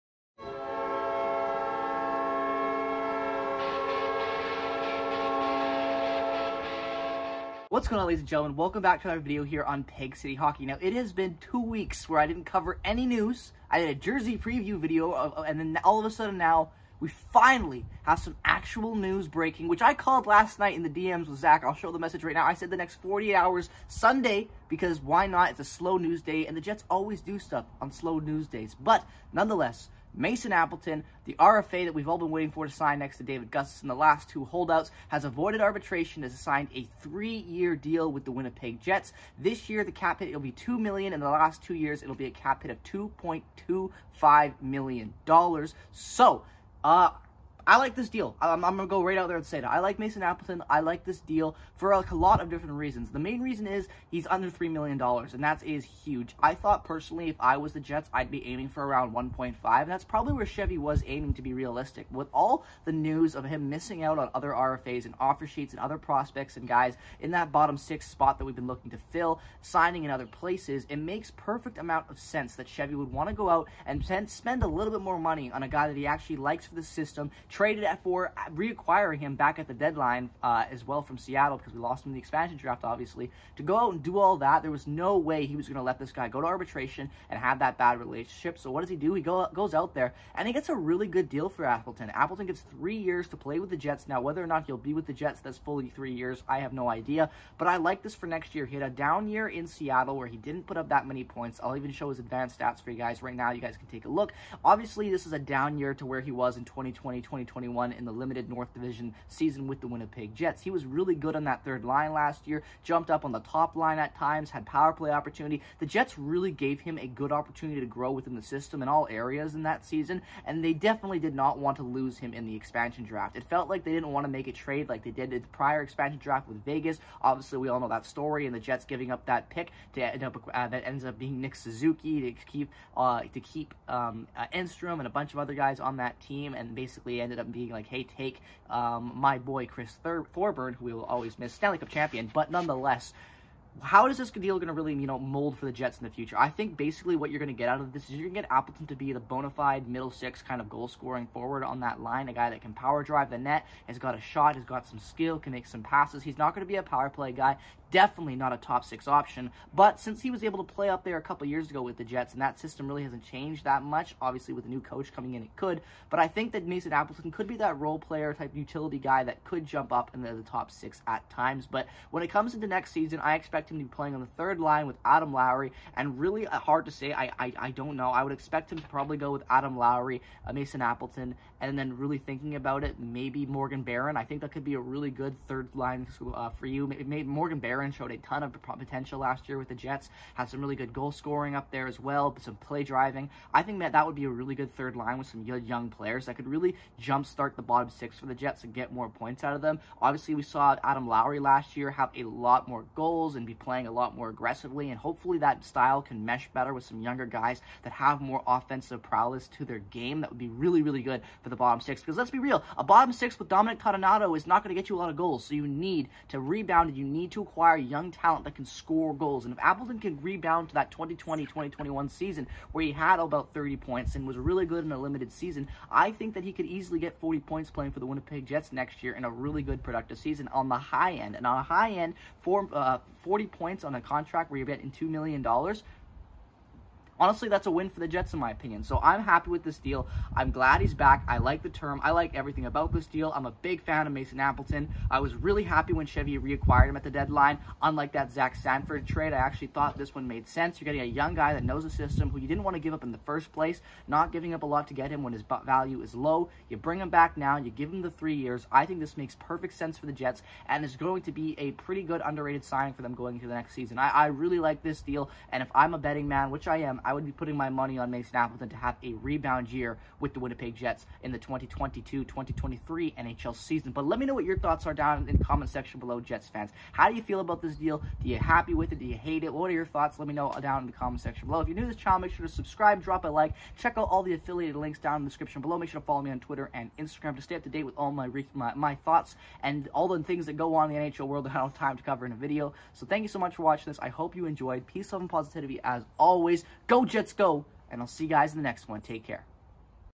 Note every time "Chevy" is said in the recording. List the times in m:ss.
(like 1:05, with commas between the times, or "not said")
1:00, 1:12, 4:06.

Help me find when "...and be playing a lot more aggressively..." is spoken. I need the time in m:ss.
3:23.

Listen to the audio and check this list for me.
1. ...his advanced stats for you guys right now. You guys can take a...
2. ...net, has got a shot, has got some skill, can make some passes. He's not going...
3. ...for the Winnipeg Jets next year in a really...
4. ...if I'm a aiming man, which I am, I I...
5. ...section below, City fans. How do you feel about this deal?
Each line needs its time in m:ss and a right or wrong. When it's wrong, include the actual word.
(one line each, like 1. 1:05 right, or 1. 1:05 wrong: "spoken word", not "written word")
1. 1:42 right
2. 2:33 right
3. 3:47 right
4. 4:25 wrong: "betting", not "aiming"
5. 4:35 wrong: "Jets", not "City".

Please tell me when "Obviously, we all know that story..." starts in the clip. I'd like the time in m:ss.
2:07.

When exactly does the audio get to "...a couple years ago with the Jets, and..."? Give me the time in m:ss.
2:41.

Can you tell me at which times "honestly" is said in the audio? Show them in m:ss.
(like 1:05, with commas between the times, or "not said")
3:57.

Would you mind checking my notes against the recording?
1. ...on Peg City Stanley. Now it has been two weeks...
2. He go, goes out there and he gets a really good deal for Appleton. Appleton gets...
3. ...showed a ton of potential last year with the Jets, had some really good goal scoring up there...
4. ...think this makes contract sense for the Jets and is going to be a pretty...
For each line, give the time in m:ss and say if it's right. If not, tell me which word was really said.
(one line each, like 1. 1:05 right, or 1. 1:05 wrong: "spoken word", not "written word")
1. 0:09 wrong: "Hockey", not "Stanley"
2. 1:29 right
3. 3:07 right
4. 4:18 wrong: "perfect", not "contract".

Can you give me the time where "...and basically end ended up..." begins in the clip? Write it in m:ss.
2:16.